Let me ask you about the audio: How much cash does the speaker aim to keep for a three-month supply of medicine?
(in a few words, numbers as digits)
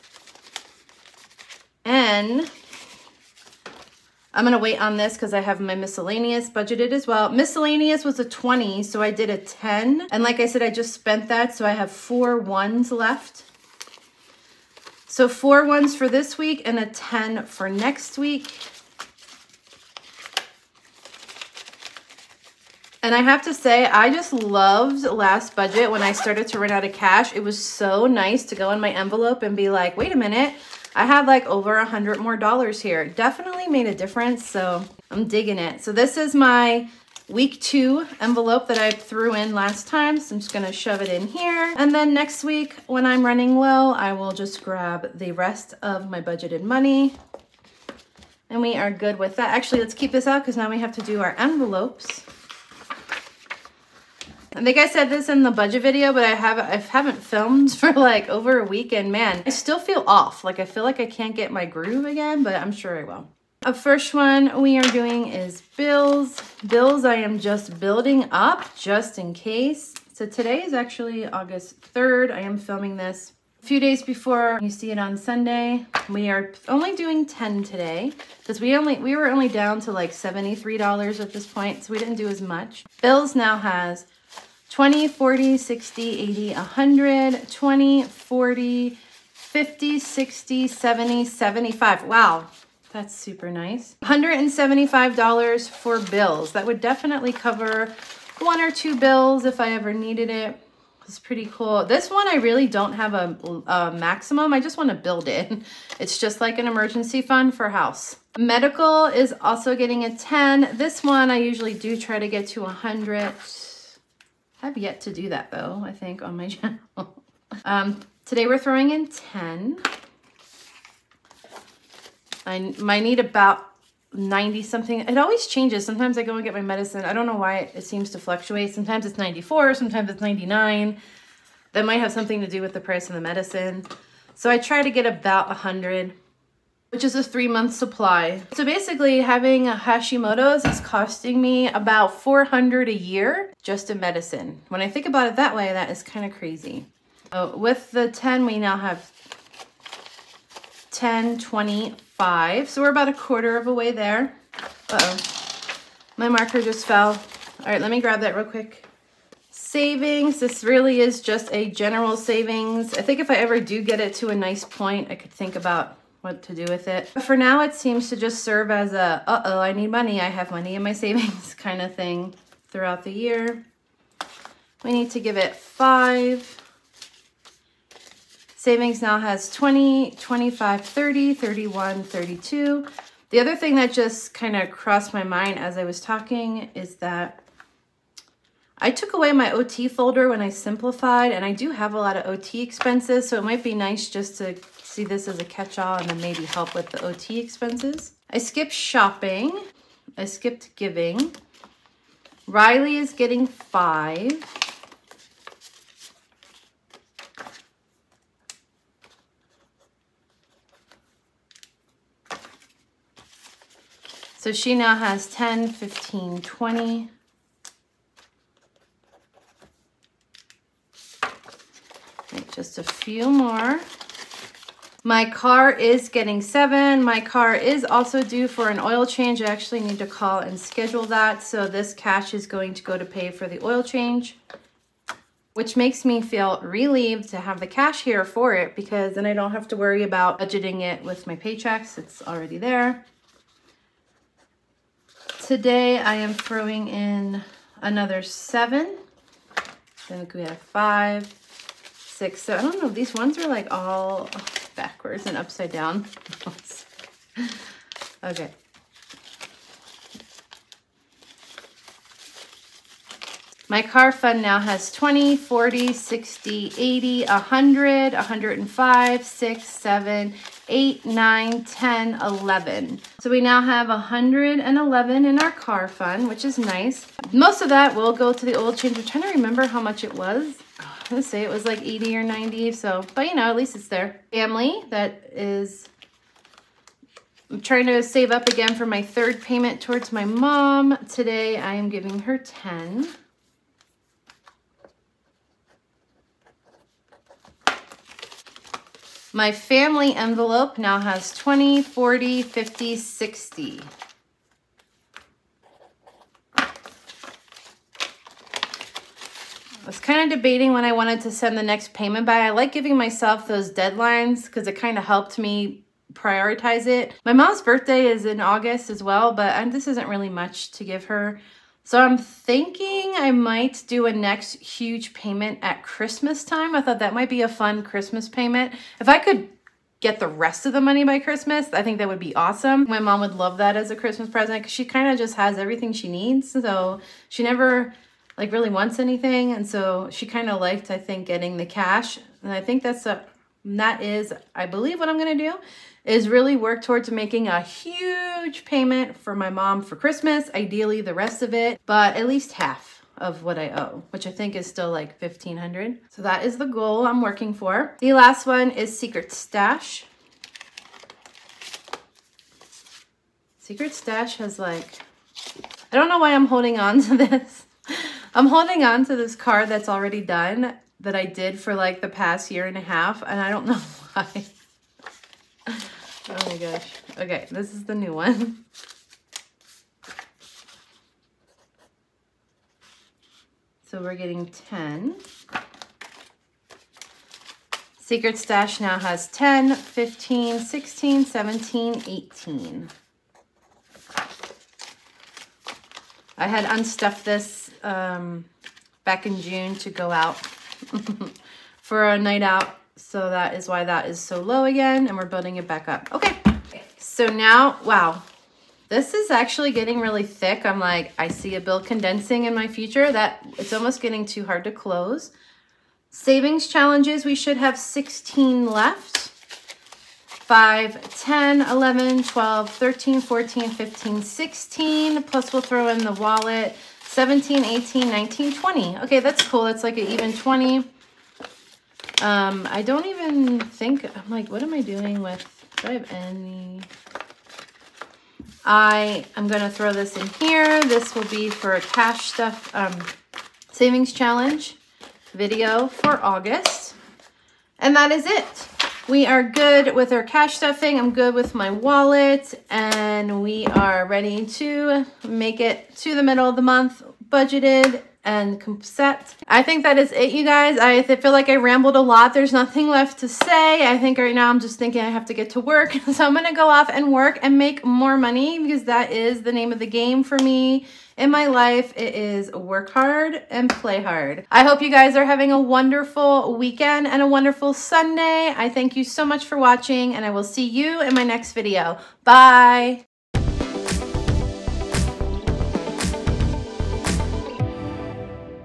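100.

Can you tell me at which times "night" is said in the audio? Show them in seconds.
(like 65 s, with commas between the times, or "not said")
402 s.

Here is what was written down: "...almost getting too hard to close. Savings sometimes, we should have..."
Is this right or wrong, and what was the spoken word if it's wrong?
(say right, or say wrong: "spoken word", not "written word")
wrong: "challenges", not "sometimes".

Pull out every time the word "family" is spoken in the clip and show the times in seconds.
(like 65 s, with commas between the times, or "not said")
284 s, 299 s.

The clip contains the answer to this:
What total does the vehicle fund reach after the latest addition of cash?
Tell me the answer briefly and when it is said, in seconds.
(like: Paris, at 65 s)
111, at 273 s.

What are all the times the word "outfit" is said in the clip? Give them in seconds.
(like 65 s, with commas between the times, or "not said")
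not said.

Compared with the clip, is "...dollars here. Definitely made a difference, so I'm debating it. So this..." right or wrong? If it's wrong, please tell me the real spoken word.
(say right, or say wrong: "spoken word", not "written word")
wrong: "digging", not "debating".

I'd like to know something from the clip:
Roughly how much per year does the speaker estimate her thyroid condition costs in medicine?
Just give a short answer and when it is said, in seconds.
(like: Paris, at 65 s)
400, at 142 s.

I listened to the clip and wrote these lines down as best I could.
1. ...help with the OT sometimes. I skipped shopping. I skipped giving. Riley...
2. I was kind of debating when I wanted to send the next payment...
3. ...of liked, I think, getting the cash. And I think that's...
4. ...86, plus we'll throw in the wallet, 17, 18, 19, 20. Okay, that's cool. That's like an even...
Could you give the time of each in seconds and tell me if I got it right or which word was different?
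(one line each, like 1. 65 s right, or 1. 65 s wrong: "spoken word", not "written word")
1. 196 s wrong: "expenses", not "sometimes"
2. 306 s right
3. 340 s right
4. 424 s wrong: "16", not "86".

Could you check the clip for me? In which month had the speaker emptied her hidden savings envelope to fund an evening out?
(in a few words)
June.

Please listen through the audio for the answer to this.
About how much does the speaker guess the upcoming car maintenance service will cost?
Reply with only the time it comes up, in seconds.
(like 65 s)
281 s.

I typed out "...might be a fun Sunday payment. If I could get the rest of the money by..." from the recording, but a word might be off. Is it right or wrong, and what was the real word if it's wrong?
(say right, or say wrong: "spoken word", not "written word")
wrong: "Christmas", not "Sunday".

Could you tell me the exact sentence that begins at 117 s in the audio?
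um, today we're throwing in 10.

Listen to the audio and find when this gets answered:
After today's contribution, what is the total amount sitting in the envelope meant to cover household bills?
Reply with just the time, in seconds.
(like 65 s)
94 s.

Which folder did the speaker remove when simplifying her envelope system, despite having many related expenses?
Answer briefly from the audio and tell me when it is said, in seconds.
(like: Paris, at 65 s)
OT folder, at 189 s.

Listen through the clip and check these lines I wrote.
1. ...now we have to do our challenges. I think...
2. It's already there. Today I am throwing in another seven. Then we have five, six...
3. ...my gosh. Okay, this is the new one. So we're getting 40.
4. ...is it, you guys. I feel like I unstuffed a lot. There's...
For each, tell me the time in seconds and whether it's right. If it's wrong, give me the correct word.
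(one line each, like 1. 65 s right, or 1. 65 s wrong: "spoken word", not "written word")
1. 50 s wrong: "envelopes", not "challenges"
2. 241 s right
3. 376 s wrong: "10", not "40"
4. 459 s wrong: "rambled", not "unstuffed".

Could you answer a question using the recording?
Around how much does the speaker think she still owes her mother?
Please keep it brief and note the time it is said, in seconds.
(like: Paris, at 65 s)
1500, at 355 s.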